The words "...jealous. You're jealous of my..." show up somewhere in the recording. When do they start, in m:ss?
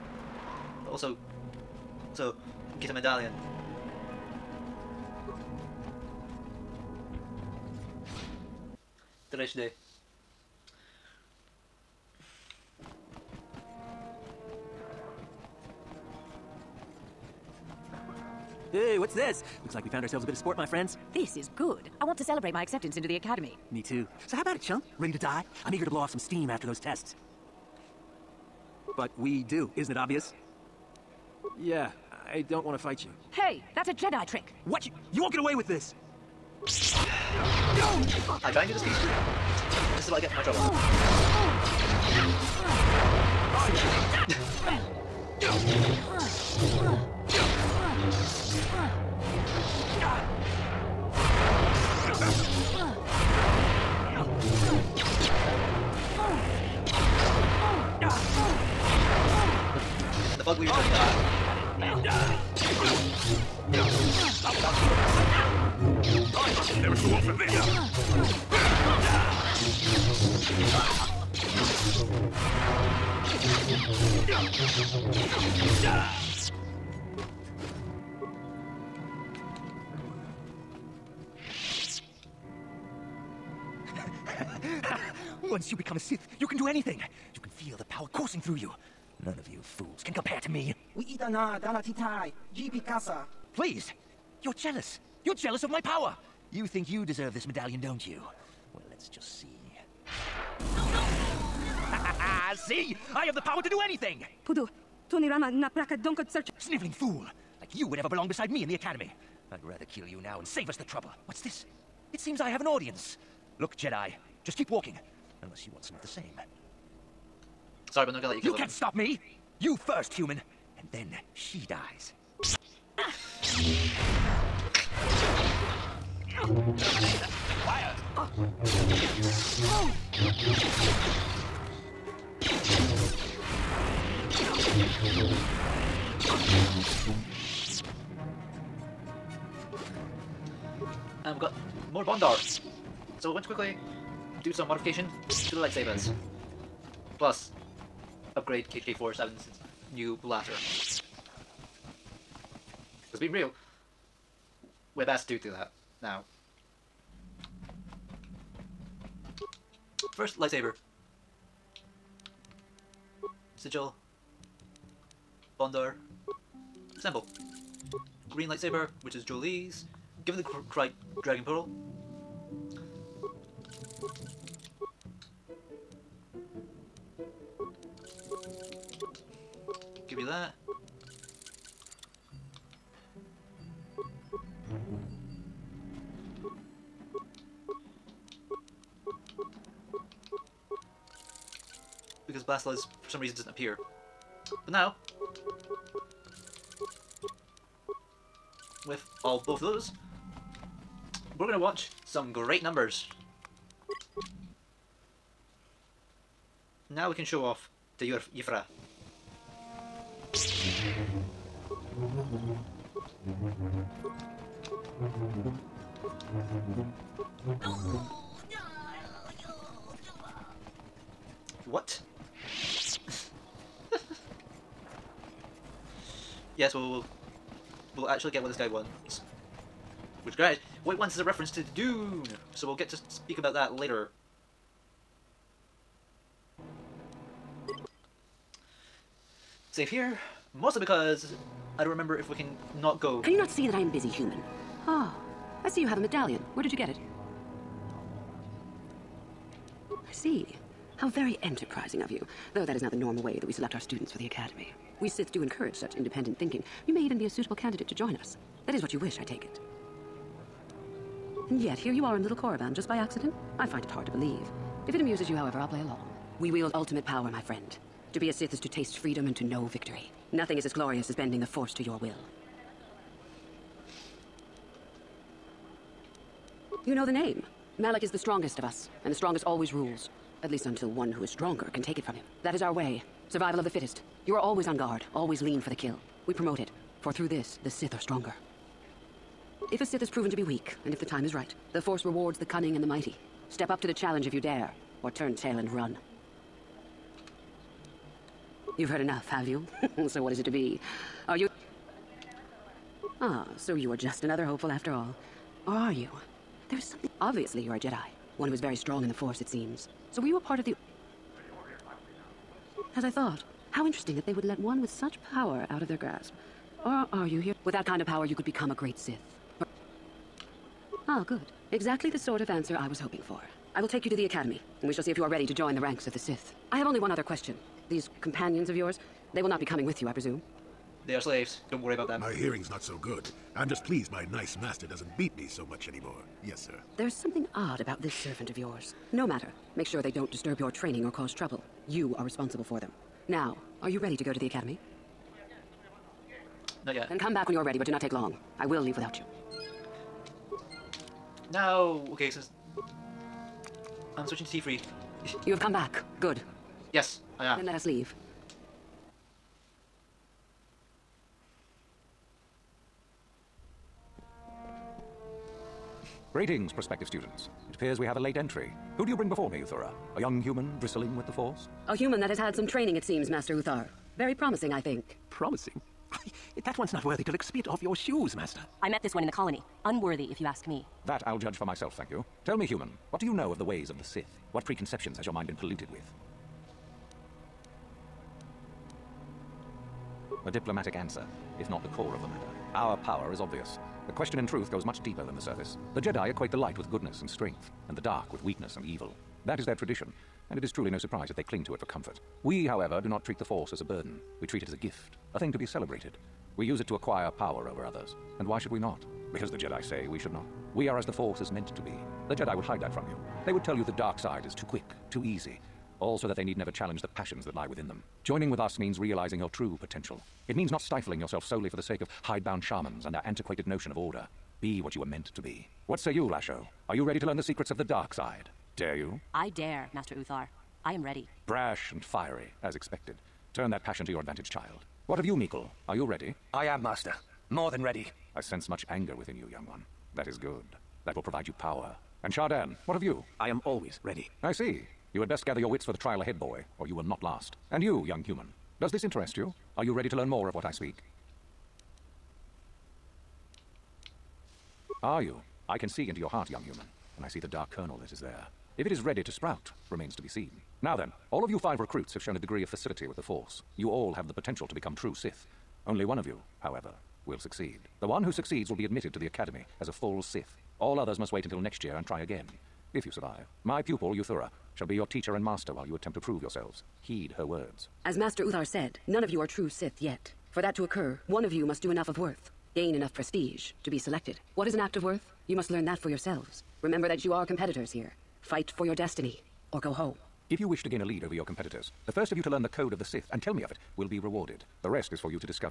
1:34.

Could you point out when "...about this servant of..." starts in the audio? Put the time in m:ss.
5:37.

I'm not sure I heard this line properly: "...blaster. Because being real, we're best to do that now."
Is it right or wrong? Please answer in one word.
right.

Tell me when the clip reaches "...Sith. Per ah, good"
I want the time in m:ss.
5:18.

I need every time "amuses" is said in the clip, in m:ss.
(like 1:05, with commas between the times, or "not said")
4:24.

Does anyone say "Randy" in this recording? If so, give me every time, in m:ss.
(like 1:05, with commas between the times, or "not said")
not said.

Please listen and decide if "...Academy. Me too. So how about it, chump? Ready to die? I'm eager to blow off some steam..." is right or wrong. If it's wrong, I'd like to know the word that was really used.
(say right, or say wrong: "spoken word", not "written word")
right.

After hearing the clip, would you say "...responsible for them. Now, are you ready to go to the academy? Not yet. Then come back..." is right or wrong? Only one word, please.
right.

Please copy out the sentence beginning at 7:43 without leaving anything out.
You all have the potential to become true Sith.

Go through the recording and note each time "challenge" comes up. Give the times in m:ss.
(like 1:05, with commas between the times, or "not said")
4:53, 6:56.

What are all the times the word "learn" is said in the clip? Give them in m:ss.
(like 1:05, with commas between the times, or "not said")
7:07, 7:30, 8:05, 8:12.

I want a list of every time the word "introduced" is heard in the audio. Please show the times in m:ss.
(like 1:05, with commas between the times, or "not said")
not said.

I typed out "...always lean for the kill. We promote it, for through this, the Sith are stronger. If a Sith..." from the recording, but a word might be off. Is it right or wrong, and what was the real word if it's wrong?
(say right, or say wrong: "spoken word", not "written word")
right.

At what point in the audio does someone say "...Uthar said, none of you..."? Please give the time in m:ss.
7:58.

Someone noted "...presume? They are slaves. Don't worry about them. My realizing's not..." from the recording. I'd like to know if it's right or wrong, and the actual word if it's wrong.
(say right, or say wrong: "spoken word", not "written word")
wrong: "hearing", not "realizing".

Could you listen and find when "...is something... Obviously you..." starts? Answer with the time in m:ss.
5:06.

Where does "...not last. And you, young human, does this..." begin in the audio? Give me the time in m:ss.
7:27.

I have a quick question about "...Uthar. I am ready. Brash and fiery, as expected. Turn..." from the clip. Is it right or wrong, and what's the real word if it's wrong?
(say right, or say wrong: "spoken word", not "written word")
right.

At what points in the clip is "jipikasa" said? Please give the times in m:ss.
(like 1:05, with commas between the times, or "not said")
1:32.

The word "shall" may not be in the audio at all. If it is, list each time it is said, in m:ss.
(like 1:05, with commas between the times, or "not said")
5:24, 7:54.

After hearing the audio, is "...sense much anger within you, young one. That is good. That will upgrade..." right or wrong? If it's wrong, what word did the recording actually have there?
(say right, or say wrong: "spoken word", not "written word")
wrong: "provide", not "upgrade".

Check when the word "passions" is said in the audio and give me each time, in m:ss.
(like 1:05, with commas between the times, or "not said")
6:57, 7:13.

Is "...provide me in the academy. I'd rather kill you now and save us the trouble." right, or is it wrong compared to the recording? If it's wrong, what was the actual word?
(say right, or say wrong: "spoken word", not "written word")
wrong: "beside", not "provide".